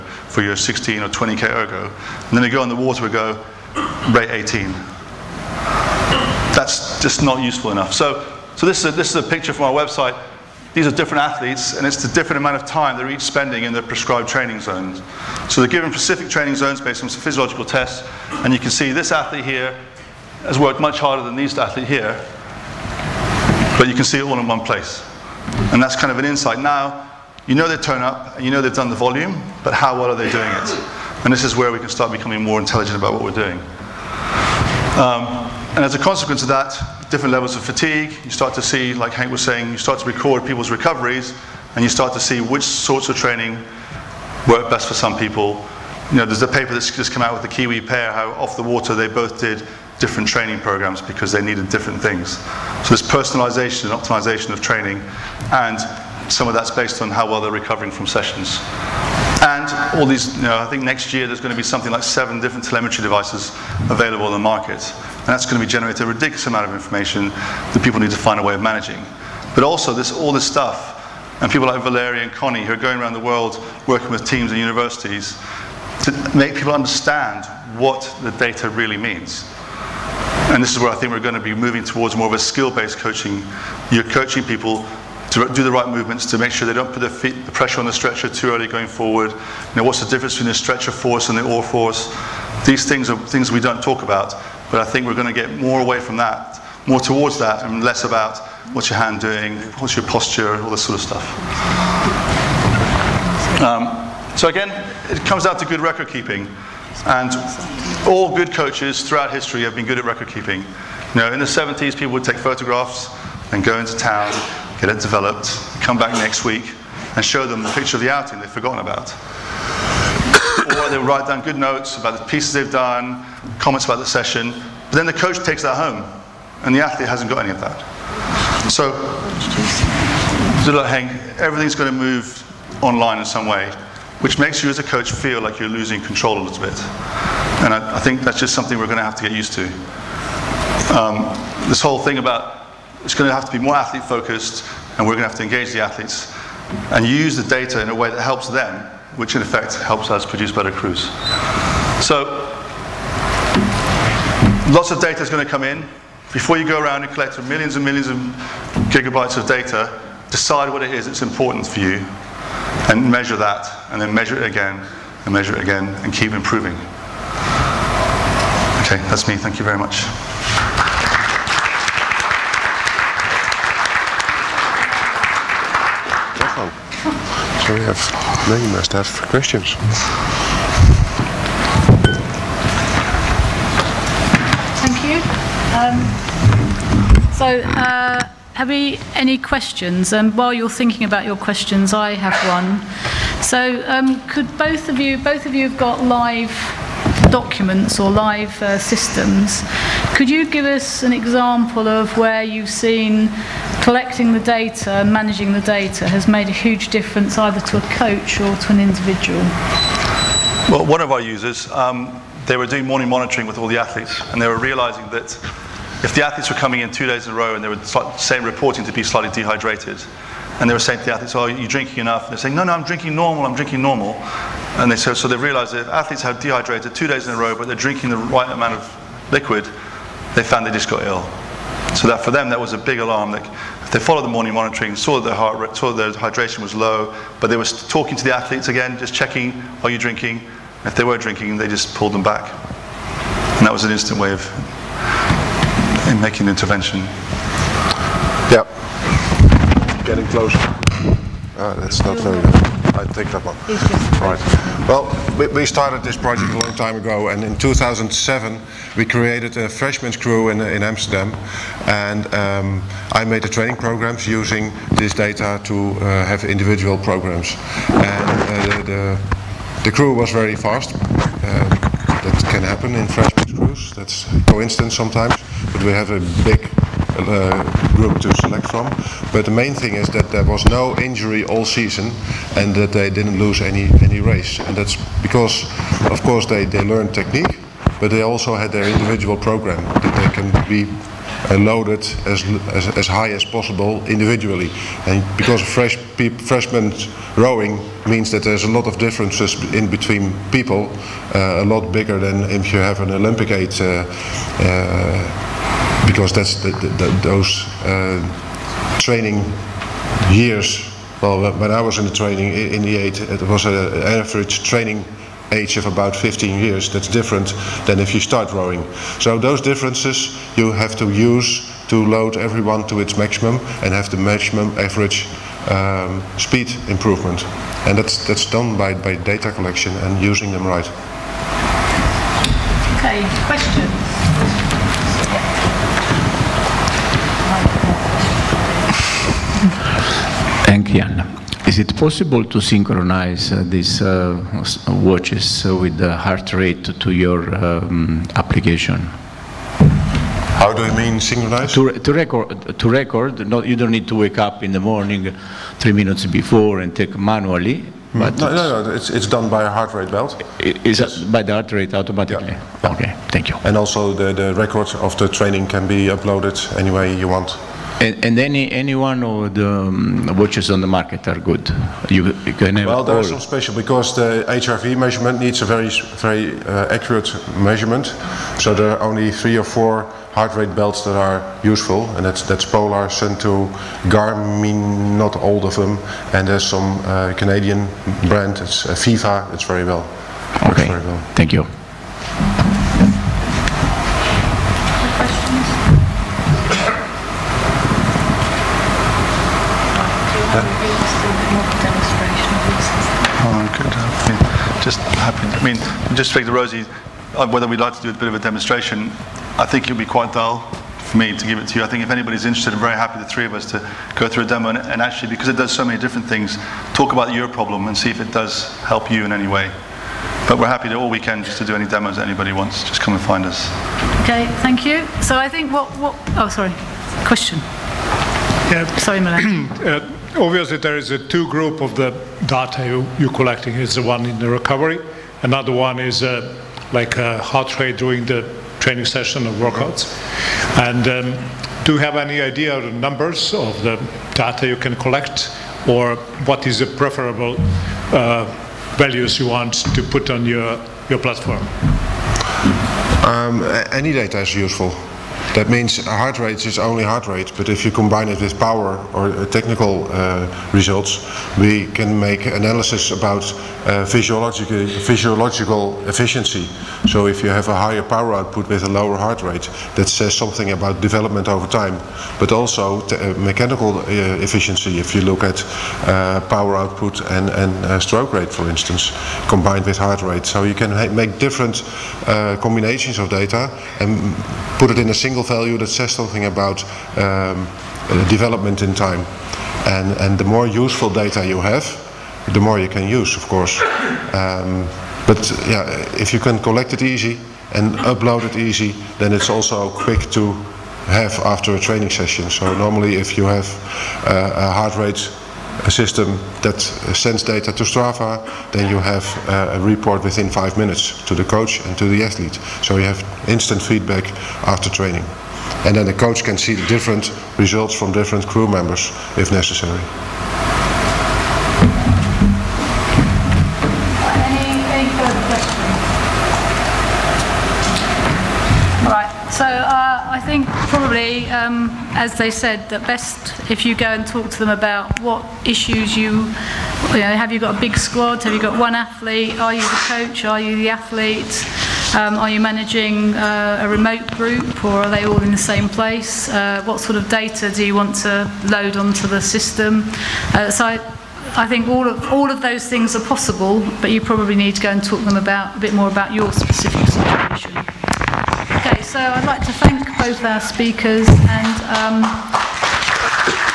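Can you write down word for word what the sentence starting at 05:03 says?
Uh, uh, because that's the, the, those uh, training years.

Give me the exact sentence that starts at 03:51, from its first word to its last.
So that for them, that was a big alarm.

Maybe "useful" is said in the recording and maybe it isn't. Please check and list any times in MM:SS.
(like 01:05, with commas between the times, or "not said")
00:07, 06:21, 07:34, 08:10.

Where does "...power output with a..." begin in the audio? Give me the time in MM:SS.
07:48.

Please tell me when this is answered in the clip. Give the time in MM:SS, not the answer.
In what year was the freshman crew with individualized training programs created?
04:17.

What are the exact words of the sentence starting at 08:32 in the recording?
So you have instant feedback after training.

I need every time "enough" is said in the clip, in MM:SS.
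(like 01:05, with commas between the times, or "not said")
00:07, 03:41.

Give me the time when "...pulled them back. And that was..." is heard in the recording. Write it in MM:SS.
04:01.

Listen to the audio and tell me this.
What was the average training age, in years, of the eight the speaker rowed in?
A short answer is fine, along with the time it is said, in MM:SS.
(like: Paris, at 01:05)
15, at 05:16.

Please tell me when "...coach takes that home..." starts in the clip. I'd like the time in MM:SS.
02:05.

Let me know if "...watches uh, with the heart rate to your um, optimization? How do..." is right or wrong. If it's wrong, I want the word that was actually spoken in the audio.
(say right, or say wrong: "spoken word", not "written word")
wrong: "application", not "optimization".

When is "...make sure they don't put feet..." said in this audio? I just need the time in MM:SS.
01:26.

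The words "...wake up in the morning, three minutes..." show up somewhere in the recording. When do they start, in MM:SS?
05:54.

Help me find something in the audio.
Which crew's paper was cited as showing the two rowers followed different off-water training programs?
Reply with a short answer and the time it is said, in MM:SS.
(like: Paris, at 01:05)
the Kiwi pair, at 00:47.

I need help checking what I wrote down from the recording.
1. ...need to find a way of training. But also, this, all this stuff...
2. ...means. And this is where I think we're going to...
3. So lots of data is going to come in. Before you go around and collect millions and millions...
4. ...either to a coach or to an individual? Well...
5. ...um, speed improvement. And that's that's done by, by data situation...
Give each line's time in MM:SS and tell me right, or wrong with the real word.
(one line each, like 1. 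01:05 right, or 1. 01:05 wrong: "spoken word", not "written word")
1. 01:07 wrong: "managing", not "training"
2. 01:18 right
3. 02:32 right
4. 03:27 right
5. 05:25 wrong: "collection", not "situation".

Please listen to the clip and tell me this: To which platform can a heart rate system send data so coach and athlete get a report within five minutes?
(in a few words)
Strava.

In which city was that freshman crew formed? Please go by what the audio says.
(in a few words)
Amsterdam.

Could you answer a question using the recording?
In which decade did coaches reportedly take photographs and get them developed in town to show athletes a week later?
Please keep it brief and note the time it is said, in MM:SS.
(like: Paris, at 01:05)
the 70s, at 01:51.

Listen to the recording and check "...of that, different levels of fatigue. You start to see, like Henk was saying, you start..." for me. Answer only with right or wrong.
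right.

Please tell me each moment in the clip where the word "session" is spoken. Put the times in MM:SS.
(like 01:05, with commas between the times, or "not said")
00:58, 02:04, 07:19, 08:22.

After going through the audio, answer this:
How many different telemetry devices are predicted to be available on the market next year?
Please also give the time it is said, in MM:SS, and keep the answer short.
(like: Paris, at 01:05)
7, at 01:02.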